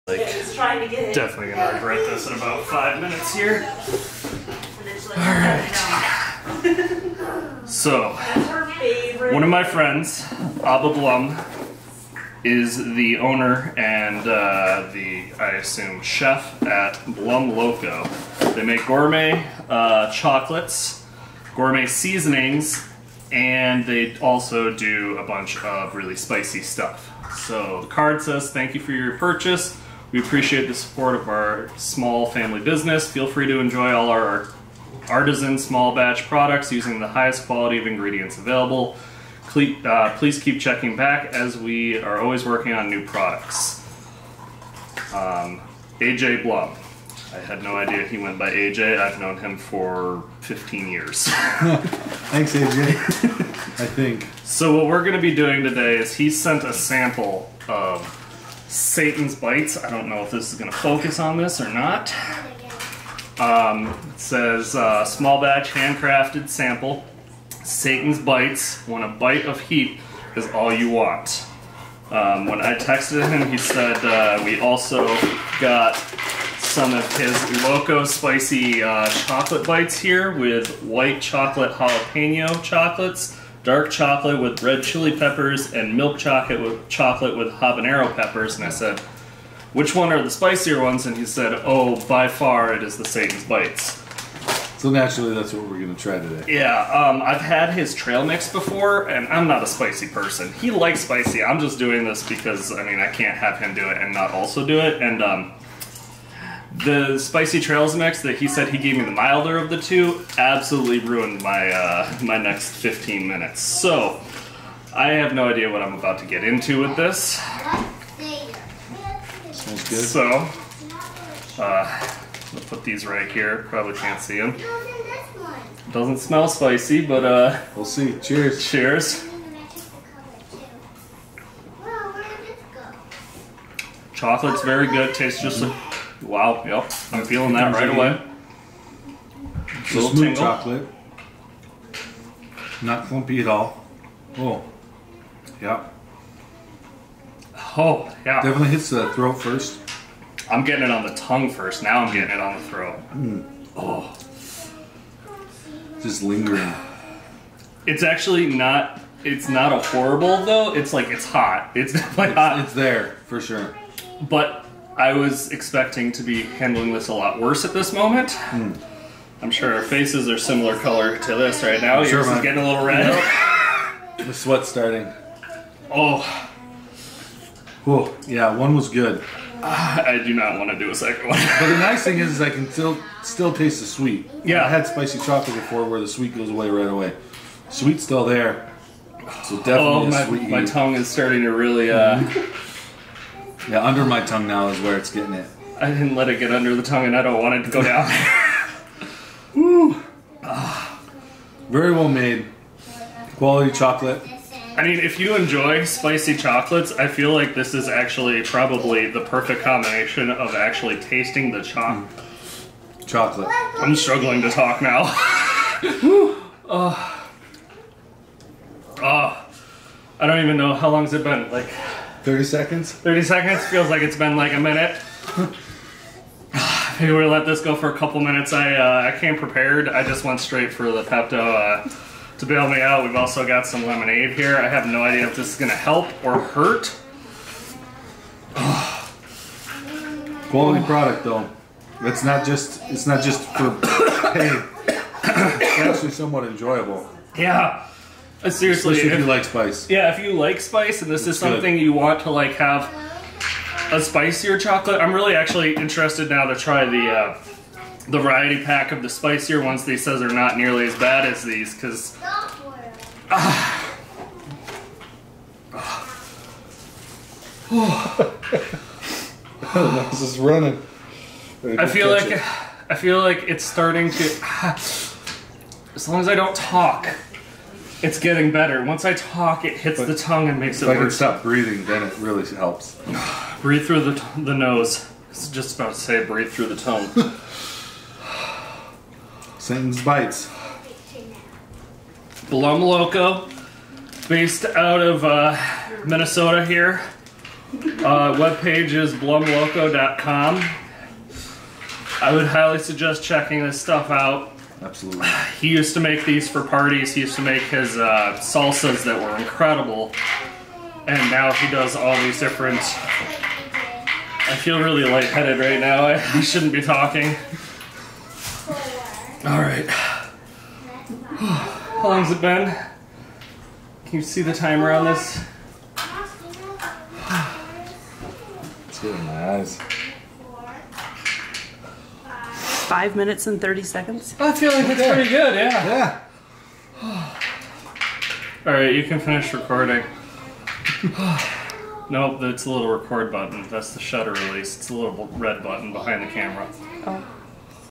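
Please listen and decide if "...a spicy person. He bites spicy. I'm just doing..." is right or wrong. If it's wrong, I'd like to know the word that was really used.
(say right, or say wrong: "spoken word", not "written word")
wrong: "likes", not "bites".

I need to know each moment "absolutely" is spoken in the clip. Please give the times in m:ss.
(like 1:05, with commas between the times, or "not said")
1:50, 5:04.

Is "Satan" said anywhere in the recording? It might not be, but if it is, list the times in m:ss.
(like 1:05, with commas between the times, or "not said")
0:58, 1:07, 1:33, 4:49.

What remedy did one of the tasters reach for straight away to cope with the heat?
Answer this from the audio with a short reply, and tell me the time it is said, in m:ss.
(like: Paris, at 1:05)
Pepto, at 3:51.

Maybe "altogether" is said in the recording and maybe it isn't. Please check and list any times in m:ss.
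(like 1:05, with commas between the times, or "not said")
not said.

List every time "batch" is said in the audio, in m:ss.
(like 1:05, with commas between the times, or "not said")
0:35, 1:05.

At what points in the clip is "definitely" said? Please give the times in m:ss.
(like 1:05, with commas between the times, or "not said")
0:01, 2:28, 2:41, 3:09.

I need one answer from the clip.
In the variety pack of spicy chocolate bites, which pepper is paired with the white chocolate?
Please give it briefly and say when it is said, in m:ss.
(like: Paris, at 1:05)
Jalapeno, at 1:20.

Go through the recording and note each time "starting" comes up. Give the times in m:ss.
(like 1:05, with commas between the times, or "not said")
2:54, 3:11, 4:33.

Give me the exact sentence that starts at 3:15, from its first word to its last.
I didn't let it get under the tongue, and I don't want it to go down.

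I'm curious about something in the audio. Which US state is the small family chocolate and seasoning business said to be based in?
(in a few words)
Minnesota.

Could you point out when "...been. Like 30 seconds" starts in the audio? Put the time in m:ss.
3:41.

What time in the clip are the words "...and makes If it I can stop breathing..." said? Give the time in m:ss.
4:40.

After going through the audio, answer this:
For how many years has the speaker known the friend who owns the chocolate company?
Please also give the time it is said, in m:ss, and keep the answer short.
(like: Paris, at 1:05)
15, at 0:48.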